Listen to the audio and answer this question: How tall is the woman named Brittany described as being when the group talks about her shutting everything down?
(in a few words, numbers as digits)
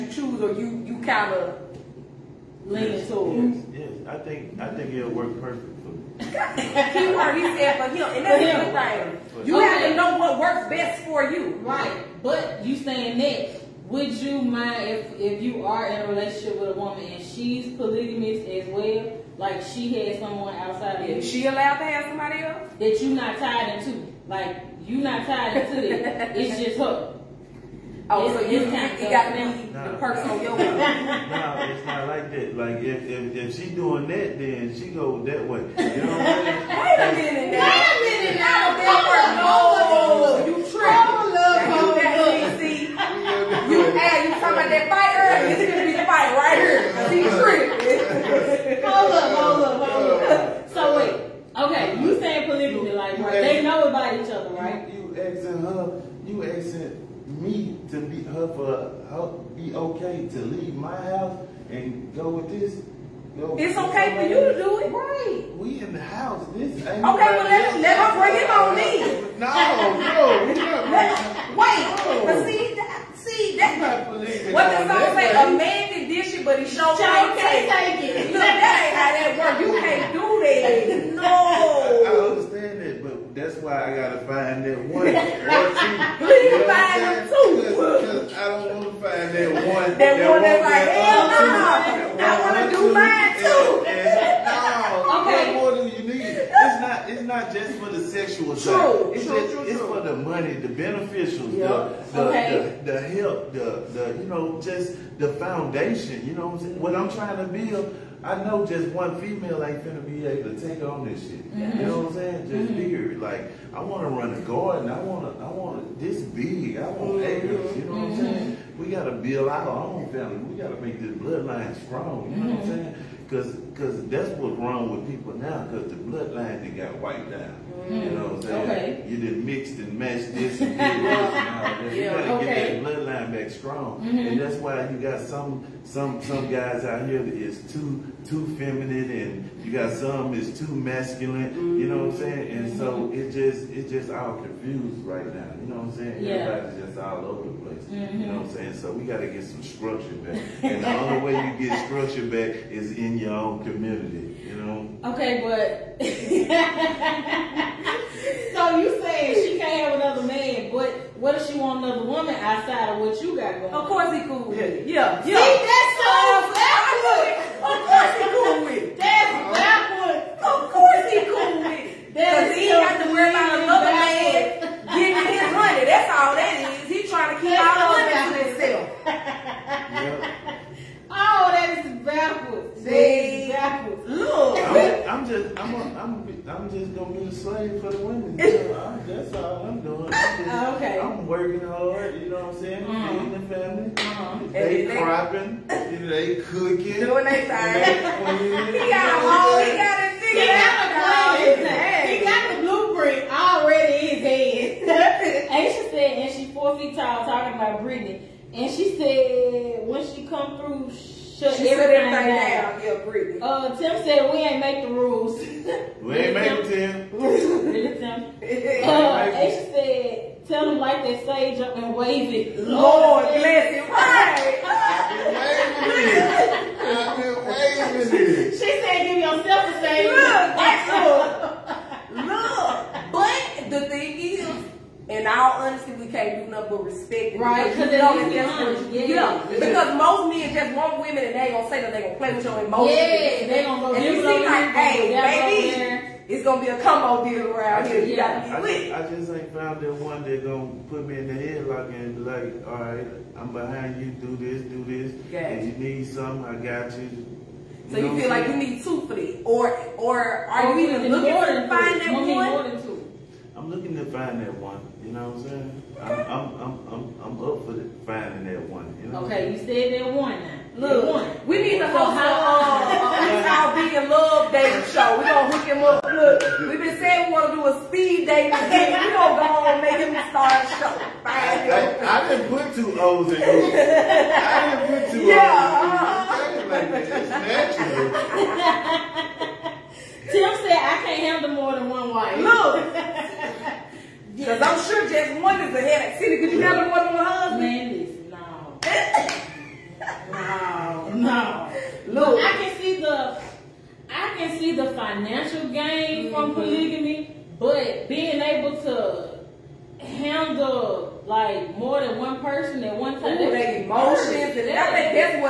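4 feet tall.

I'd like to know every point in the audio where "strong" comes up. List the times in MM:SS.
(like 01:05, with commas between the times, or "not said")
02:01, 02:13.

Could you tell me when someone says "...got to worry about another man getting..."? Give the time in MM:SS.
02:52.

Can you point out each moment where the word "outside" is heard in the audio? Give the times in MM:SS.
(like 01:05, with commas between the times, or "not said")
00:20, 02:42.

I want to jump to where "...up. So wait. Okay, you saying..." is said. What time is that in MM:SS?
00:50.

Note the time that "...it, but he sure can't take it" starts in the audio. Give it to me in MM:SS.
01:16.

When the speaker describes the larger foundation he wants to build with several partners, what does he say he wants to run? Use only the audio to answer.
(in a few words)
a garden.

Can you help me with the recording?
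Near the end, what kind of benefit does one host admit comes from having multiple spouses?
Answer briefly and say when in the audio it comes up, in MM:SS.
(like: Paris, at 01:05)
financial gain, at 05:04.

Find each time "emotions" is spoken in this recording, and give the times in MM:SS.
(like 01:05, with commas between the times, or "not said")
04:02, 05:13.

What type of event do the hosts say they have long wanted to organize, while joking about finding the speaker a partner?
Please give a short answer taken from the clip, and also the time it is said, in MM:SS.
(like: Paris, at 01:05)
speed dating, at 04:37.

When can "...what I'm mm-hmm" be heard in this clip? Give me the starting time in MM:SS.
01:58.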